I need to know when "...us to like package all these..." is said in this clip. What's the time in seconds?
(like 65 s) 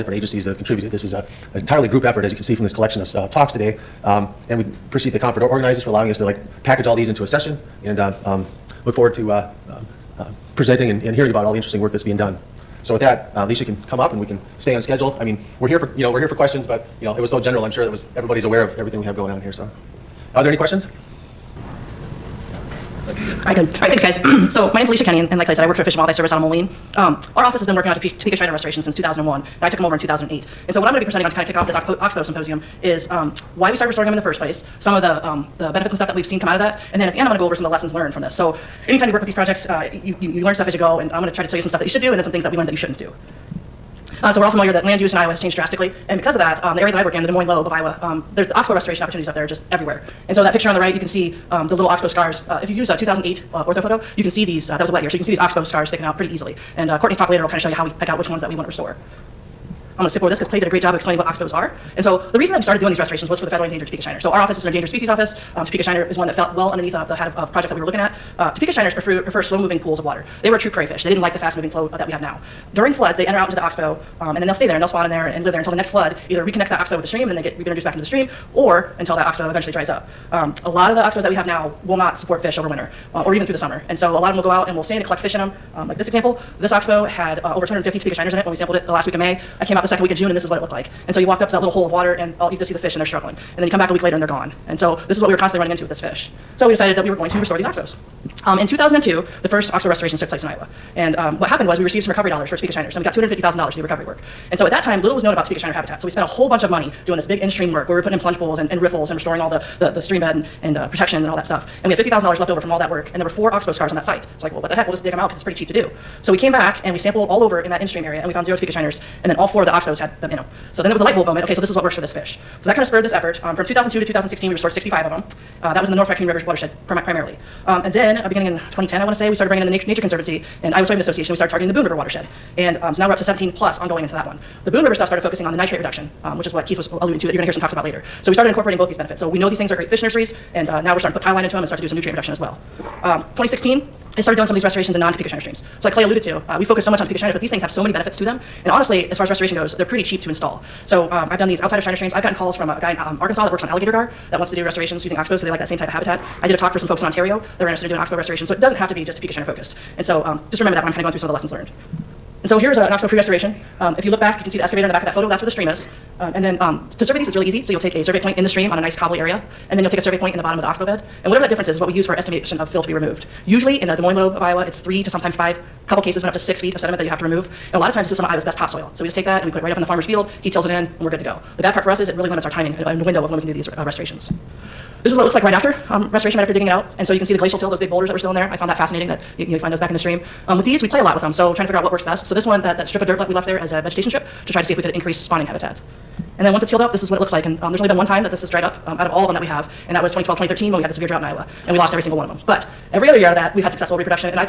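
6 s.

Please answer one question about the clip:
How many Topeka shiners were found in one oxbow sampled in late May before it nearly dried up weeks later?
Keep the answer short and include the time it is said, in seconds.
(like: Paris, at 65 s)
over 250, at 87 s.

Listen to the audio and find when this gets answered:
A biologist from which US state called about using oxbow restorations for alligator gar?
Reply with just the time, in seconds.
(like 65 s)
153 s.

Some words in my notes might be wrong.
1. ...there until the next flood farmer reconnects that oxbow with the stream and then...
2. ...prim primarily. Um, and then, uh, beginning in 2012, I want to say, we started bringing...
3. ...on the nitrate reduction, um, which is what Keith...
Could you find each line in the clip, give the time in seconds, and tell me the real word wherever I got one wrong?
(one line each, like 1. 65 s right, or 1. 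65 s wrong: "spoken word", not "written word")
1. 75 s wrong: "either", not "farmer"
2. 126 s wrong: "2010", not "2012"
3. 135 s right.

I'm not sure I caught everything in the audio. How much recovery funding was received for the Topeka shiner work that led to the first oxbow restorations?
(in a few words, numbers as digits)
$250,000.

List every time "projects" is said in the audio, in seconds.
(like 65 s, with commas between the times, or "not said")
39 s, 67 s.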